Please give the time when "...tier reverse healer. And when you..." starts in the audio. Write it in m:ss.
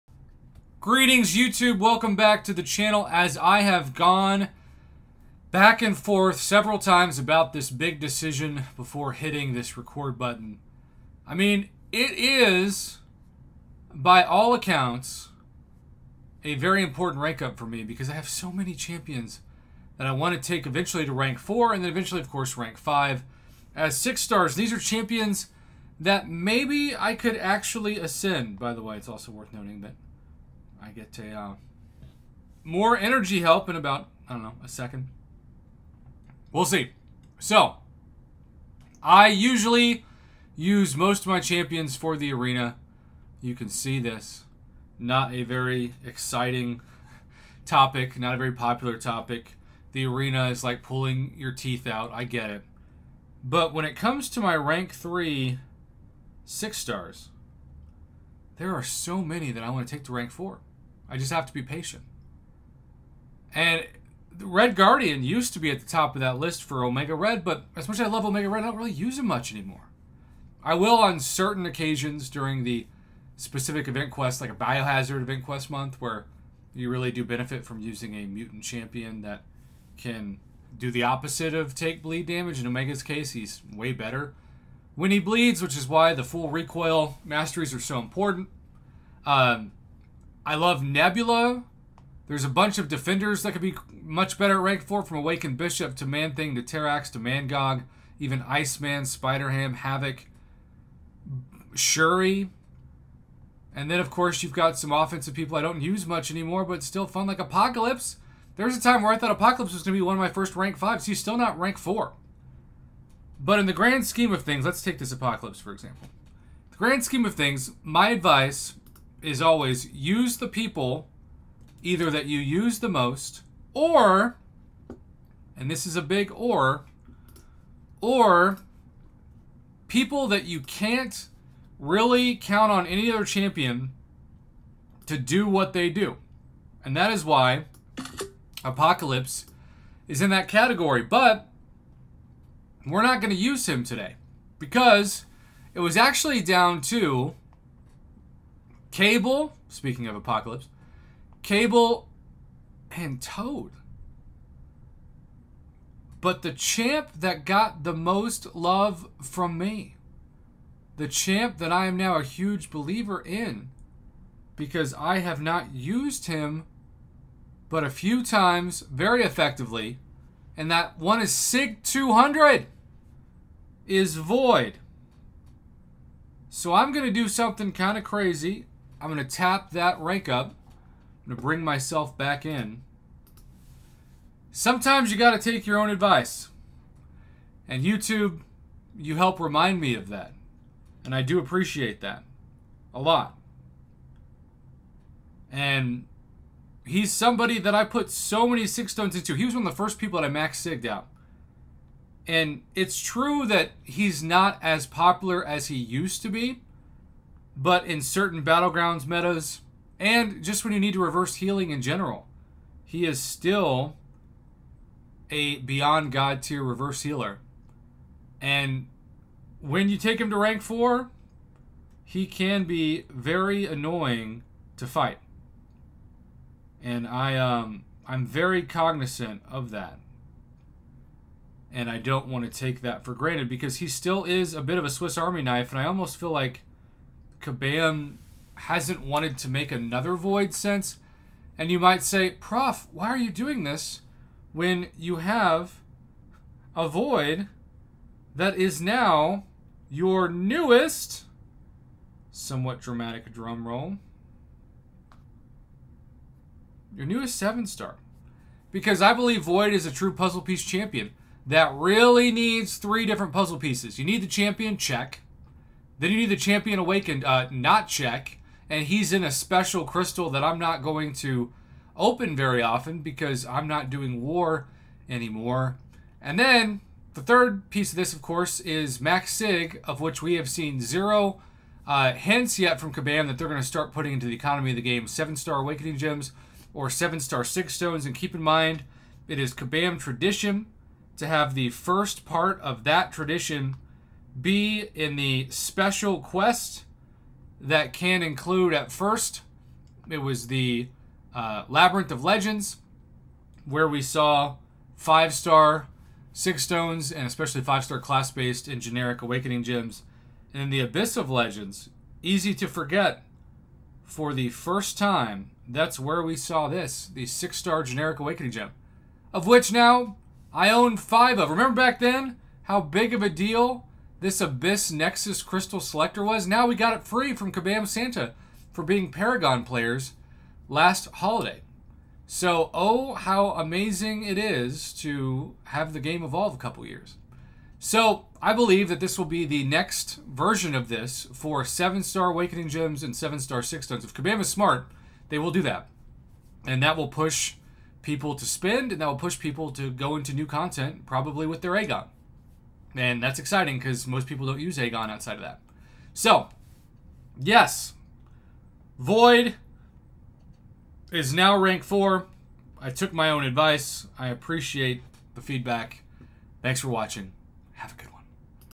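3:36.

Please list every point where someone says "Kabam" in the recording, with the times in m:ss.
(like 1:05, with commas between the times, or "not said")
3:57, 4:42, 4:49, 5:27, 5:44.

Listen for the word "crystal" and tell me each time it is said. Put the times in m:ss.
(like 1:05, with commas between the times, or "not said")
4:29, 5:25.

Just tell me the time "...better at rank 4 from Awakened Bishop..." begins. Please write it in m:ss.
1:34.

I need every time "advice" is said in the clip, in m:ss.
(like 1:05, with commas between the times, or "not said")
1:58, 3:05, 6:03.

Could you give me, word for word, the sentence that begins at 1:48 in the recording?
There was a time where I thought Apocalypse was going to be one of my first rank 5s.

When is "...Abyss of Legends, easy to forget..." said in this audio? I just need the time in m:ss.
5:10.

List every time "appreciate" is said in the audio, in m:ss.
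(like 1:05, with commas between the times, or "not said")
3:11, 6:04.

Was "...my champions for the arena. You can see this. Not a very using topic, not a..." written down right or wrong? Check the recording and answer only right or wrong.
wrong.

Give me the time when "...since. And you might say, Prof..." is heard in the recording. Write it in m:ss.
4:00.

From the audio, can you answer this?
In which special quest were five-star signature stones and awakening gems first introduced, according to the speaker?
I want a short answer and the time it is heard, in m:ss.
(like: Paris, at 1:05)
Labyrinth of Legends, at 5:01.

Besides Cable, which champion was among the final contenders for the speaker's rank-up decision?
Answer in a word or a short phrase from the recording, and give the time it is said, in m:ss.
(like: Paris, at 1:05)
Toad, at 2:33.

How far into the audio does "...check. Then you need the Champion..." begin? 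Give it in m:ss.
4:24.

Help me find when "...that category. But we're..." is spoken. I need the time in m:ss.
2:20.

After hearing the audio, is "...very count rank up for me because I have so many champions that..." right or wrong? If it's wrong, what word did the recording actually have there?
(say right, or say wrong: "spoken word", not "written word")
wrong: "important", not "count".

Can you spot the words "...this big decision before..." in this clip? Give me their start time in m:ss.
0:07.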